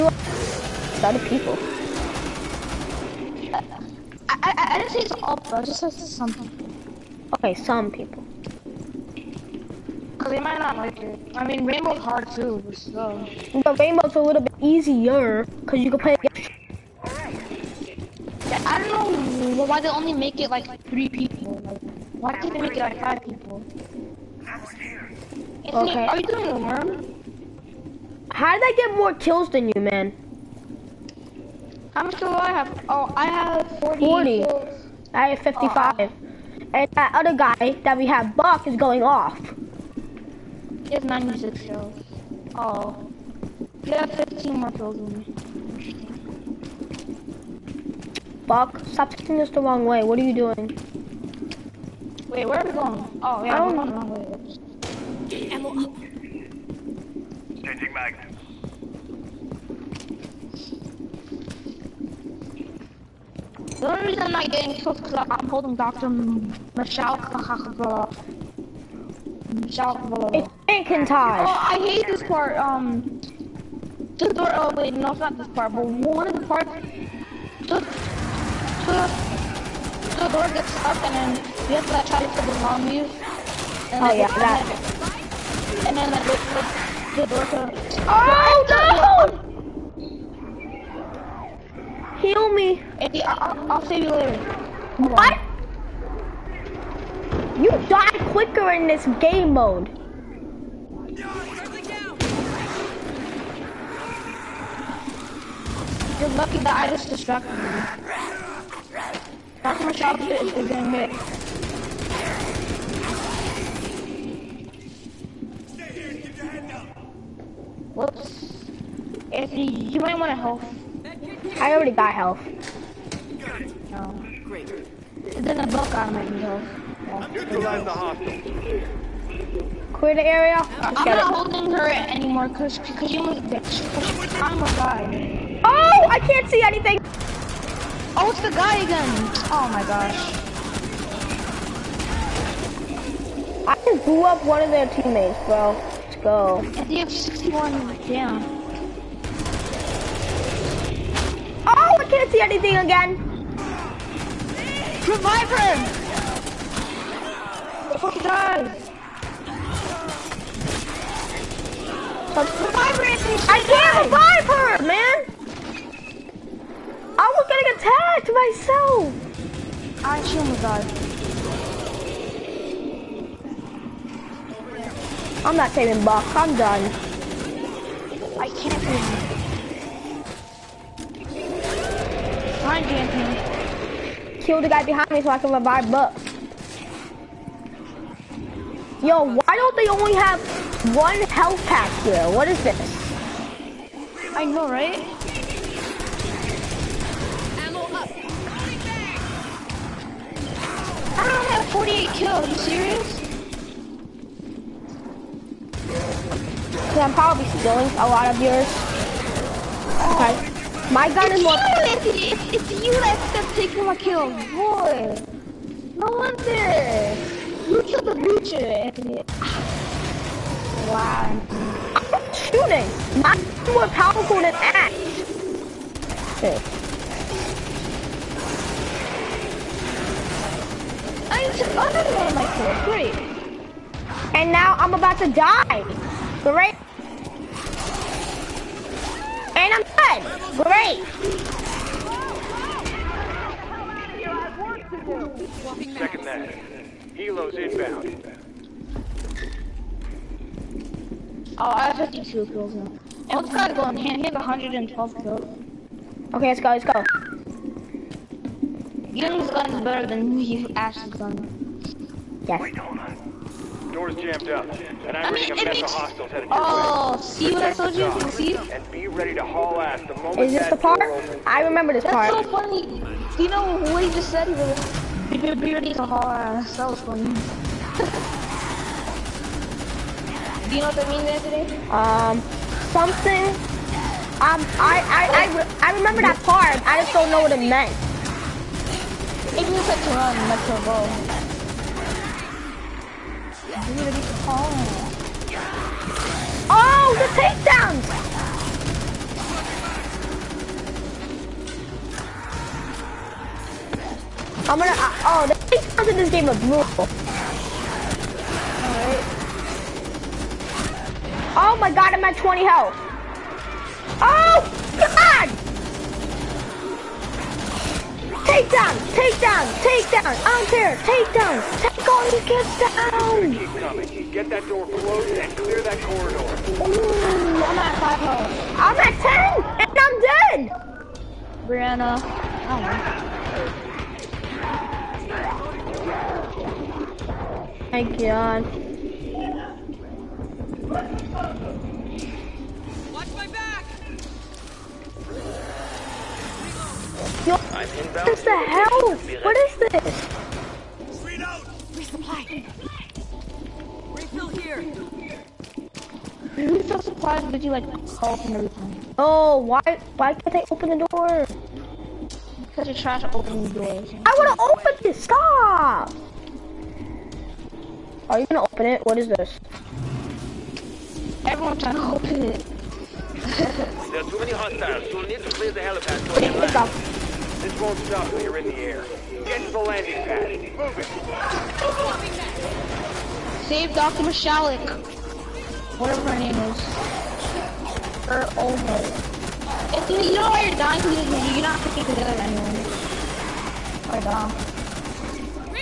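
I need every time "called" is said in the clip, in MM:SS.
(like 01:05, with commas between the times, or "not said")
05:58.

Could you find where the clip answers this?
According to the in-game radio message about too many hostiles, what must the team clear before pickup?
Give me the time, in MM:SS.
06:15.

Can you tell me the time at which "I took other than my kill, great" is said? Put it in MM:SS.
03:51.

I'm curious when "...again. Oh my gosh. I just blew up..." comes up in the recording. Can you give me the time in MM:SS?
02:18.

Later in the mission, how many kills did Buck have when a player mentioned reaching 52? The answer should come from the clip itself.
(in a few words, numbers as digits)
112.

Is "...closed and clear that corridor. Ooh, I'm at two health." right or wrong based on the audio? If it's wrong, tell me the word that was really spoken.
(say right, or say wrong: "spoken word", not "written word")
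wrong: "five", not "two".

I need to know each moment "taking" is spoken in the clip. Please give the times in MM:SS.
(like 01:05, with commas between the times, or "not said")
00:49, 03:33.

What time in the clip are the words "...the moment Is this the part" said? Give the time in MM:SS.
04:30.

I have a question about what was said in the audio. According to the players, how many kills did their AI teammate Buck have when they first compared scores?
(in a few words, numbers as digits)
96.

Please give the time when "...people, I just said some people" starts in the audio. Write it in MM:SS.
00:05.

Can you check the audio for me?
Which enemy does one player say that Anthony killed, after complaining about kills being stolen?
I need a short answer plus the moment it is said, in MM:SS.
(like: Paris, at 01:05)
The Butcher, at 03:38.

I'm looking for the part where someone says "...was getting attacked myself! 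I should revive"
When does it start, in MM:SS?
02:47.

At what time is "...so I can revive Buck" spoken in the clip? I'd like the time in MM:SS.
03:05.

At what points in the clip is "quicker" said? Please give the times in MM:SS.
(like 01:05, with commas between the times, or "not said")
01:38.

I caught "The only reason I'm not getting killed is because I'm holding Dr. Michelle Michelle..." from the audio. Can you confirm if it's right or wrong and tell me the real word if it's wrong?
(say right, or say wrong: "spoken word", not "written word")
right.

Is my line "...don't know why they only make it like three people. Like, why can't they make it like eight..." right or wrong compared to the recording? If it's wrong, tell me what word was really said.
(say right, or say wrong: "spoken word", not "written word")
wrong: "five", not "eight".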